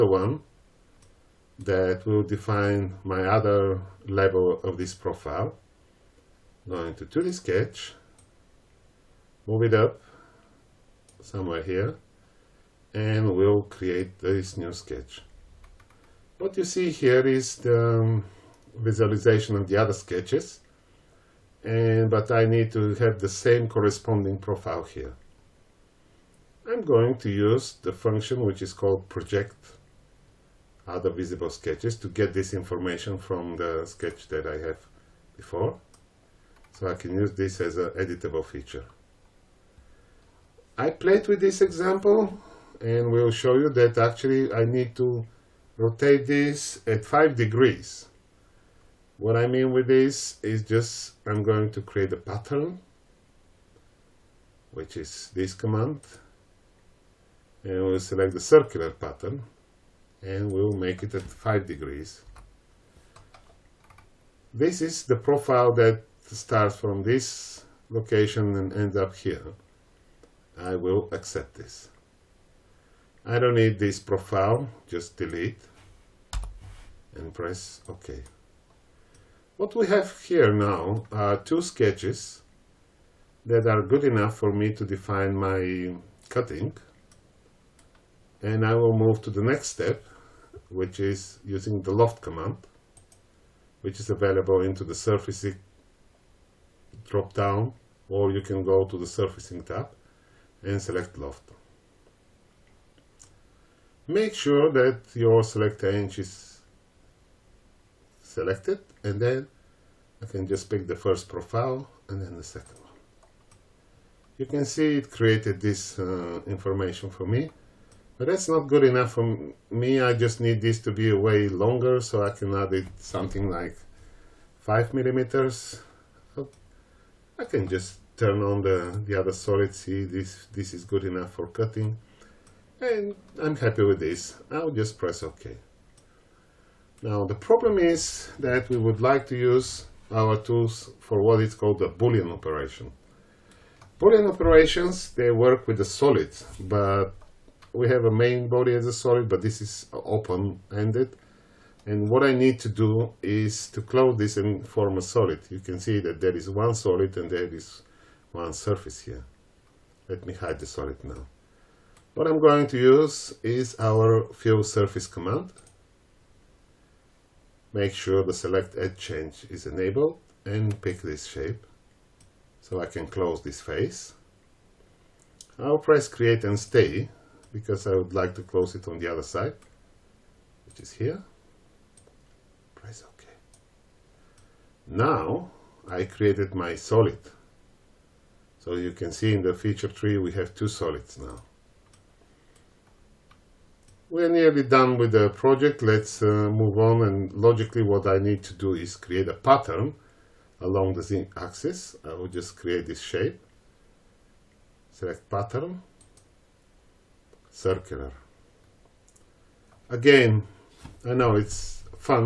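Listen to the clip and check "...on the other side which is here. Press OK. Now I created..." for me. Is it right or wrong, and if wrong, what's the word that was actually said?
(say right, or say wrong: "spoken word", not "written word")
right.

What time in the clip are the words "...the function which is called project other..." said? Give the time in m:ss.
0:27.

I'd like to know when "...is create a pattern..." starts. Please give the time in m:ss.
3:18.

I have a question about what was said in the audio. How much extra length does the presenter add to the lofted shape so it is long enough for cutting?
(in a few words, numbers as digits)
5 millimeters.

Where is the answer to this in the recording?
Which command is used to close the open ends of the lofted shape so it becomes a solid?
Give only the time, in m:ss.
2:44.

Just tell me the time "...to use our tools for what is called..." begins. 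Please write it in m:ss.
2:19.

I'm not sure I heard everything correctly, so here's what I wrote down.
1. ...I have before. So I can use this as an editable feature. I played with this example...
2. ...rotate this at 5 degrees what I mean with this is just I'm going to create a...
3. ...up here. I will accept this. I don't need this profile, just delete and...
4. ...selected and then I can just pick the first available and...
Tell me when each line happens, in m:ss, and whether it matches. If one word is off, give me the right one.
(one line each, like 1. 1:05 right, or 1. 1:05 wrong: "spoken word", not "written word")
1. 0:34 right
2. 0:45 right
3. 1:08 right
4. 1:48 wrong: "profile", not "available".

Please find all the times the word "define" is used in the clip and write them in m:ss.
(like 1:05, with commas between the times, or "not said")
0:02, 1:24.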